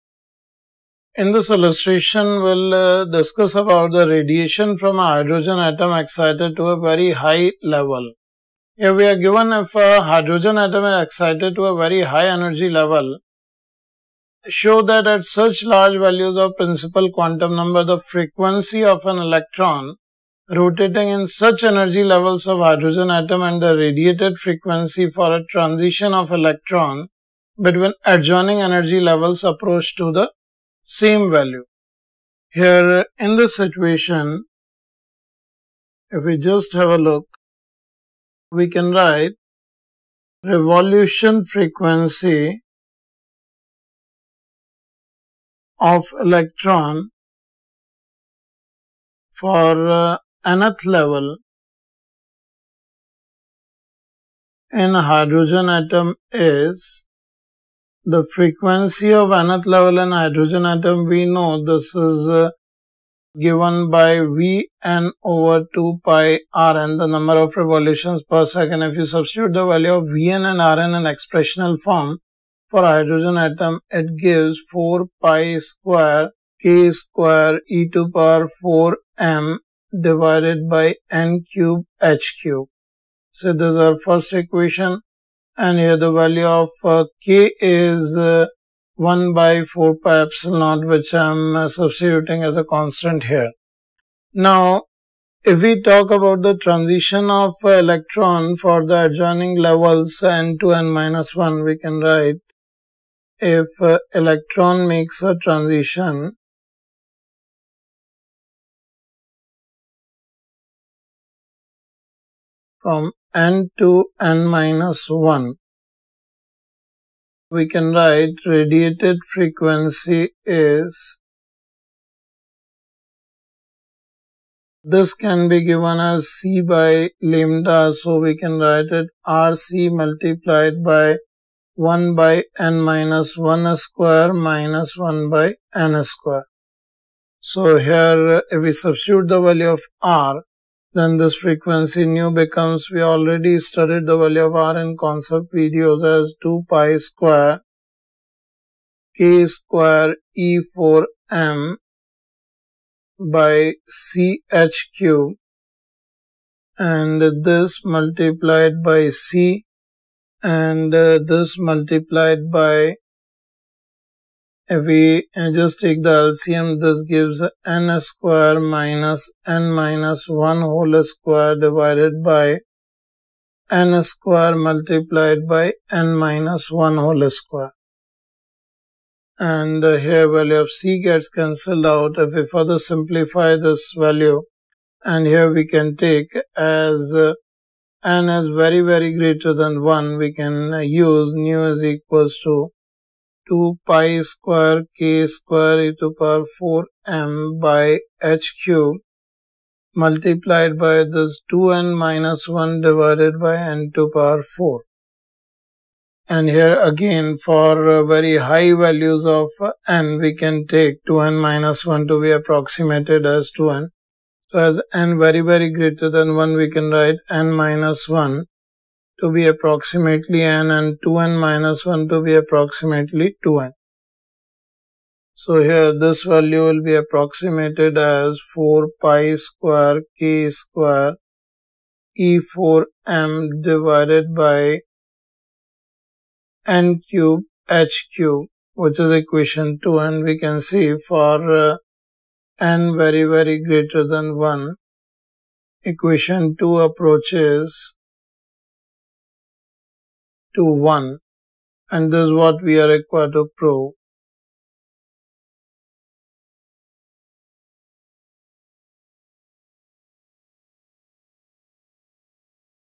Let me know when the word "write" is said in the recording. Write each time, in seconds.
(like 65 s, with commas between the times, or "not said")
38 s, 101 s, 117 s, 128 s, 216 s.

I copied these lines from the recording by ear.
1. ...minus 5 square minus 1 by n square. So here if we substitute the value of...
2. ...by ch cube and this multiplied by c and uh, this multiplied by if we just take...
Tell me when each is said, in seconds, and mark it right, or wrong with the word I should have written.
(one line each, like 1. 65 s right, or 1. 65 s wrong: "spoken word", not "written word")
1. 132 s wrong: "1", not "5"
2. 153 s right.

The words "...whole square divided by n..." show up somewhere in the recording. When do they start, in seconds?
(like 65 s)
170 s.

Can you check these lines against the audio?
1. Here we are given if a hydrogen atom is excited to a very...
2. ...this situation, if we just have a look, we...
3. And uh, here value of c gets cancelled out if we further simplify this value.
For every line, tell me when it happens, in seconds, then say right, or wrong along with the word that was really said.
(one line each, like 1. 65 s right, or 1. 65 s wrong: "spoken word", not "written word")
1. 8 s right
2. 33 s right
3. 179 s right.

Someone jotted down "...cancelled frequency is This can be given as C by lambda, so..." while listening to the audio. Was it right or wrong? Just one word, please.
wrong.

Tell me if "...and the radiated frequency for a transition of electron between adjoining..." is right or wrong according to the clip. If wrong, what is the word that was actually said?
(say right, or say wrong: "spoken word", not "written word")
right.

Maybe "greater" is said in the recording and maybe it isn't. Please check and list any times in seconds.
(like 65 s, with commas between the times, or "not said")
189 s, 215 s, 243 s.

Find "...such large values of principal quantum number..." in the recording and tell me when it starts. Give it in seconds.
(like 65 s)
15 s.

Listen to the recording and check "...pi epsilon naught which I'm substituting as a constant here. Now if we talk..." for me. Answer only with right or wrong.
right.